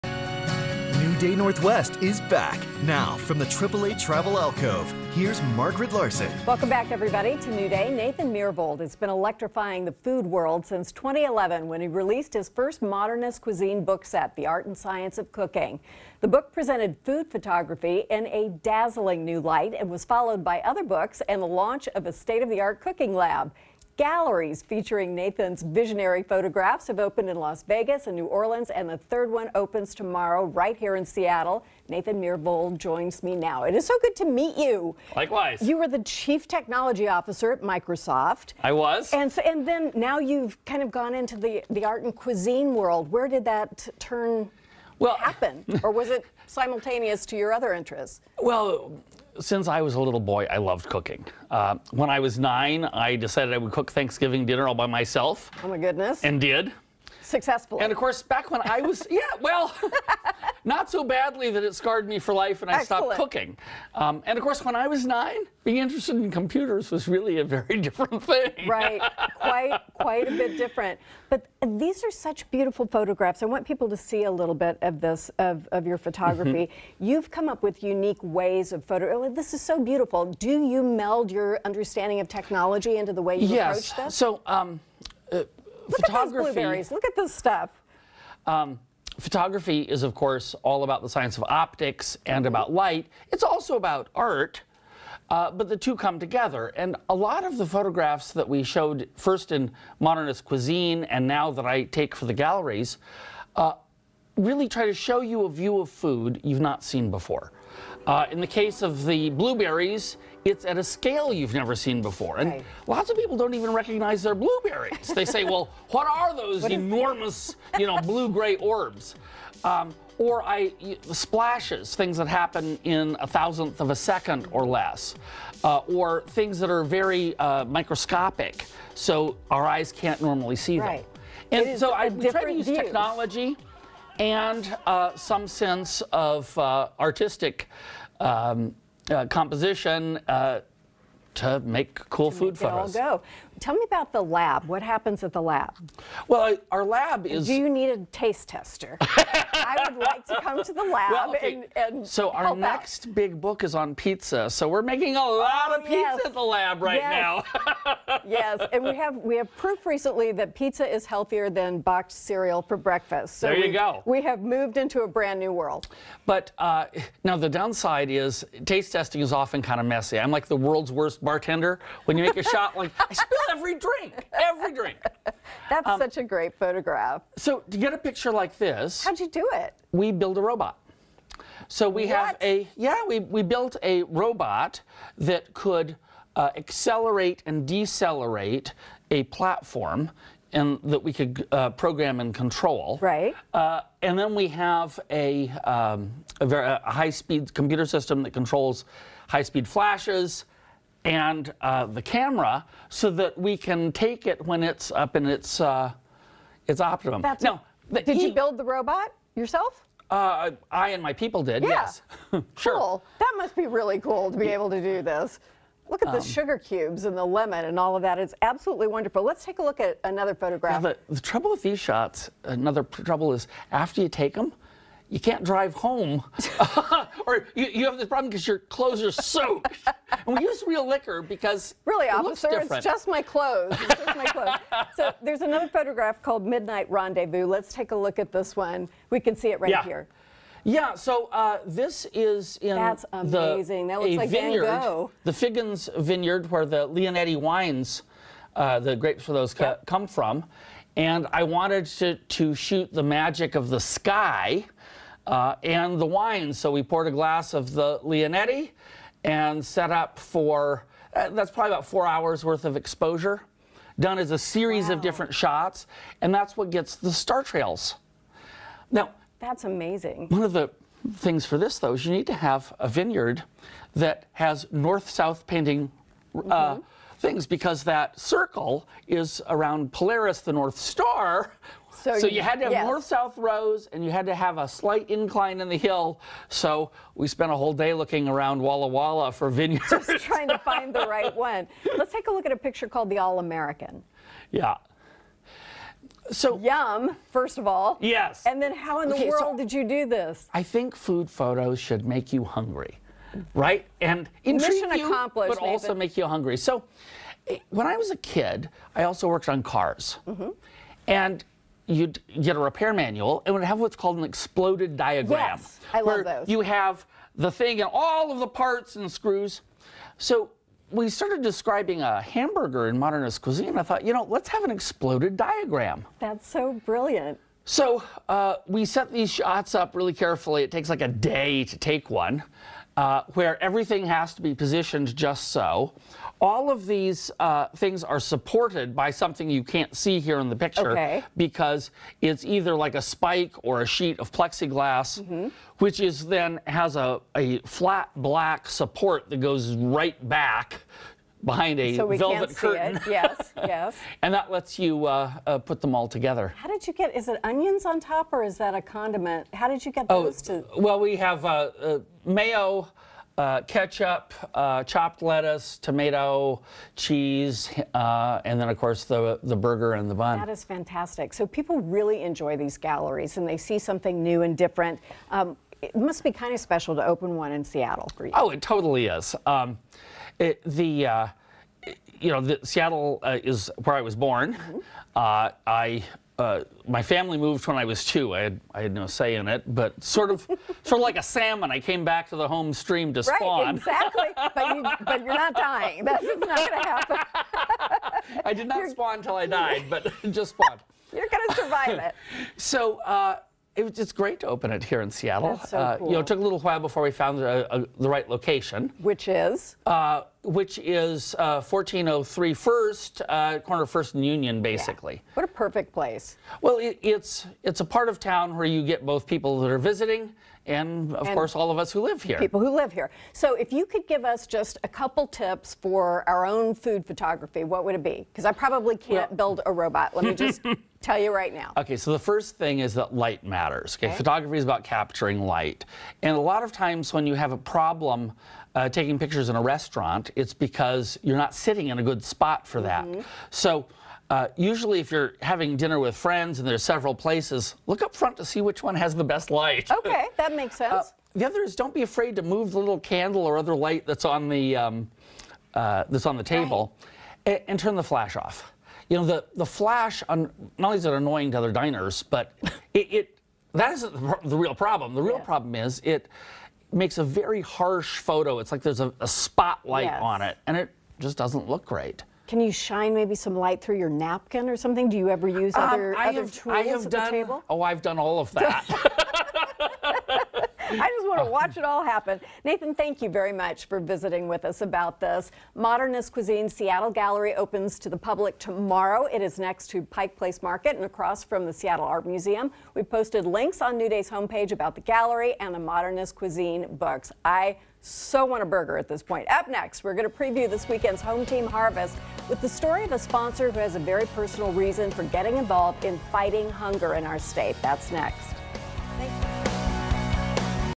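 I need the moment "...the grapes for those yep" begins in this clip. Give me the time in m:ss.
4:08.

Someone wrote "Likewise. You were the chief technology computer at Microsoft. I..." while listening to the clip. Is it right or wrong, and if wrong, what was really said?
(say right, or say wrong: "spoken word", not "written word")
wrong: "officer", not "computer".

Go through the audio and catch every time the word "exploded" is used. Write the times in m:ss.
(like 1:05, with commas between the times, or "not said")
5:14, 5:24.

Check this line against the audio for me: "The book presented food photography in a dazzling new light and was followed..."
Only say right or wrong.
right.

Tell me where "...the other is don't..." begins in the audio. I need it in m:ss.
7:31.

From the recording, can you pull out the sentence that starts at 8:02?
Nathan, thank you very much for visiting with us about this.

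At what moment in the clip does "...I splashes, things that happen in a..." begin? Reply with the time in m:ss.
2:00.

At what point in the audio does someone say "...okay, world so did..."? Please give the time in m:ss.
4:59.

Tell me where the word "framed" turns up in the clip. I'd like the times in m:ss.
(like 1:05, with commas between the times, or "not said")
not said.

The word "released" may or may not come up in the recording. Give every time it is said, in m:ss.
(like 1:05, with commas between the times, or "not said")
0:11.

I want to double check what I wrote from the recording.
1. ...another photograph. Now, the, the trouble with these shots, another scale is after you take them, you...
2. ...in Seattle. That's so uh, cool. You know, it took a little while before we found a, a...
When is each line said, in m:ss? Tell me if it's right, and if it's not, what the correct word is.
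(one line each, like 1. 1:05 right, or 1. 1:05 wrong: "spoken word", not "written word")
1. 3:40 wrong: "trouble", not "scale"
2. 6:45 right.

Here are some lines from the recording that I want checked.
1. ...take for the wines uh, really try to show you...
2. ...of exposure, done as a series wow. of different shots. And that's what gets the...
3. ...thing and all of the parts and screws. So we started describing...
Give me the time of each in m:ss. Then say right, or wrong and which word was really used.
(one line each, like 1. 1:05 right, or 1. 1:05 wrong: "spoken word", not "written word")
1. 1:41 wrong: "galleries", not "wines"
2. 4:22 right
3. 5:17 right.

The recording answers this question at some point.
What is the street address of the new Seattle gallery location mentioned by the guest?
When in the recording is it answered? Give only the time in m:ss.
6:51.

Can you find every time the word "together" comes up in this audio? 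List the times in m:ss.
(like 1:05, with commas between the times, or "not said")
1:36, 5:56.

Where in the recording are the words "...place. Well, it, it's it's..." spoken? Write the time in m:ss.
6:55.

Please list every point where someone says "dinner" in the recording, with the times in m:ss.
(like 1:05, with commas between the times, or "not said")
0:54, 7:25.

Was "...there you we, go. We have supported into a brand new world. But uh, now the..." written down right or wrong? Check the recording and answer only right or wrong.
wrong.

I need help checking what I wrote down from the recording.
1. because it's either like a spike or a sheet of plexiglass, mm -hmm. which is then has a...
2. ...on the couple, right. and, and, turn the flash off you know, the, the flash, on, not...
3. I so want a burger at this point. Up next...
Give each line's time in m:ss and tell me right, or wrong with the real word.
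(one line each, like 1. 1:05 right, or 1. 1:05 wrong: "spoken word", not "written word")
1. 5:41 right
2. 7:36 wrong: "table", not "couple"
3. 8:17 right.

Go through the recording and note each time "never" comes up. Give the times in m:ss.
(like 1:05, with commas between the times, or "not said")
1:51.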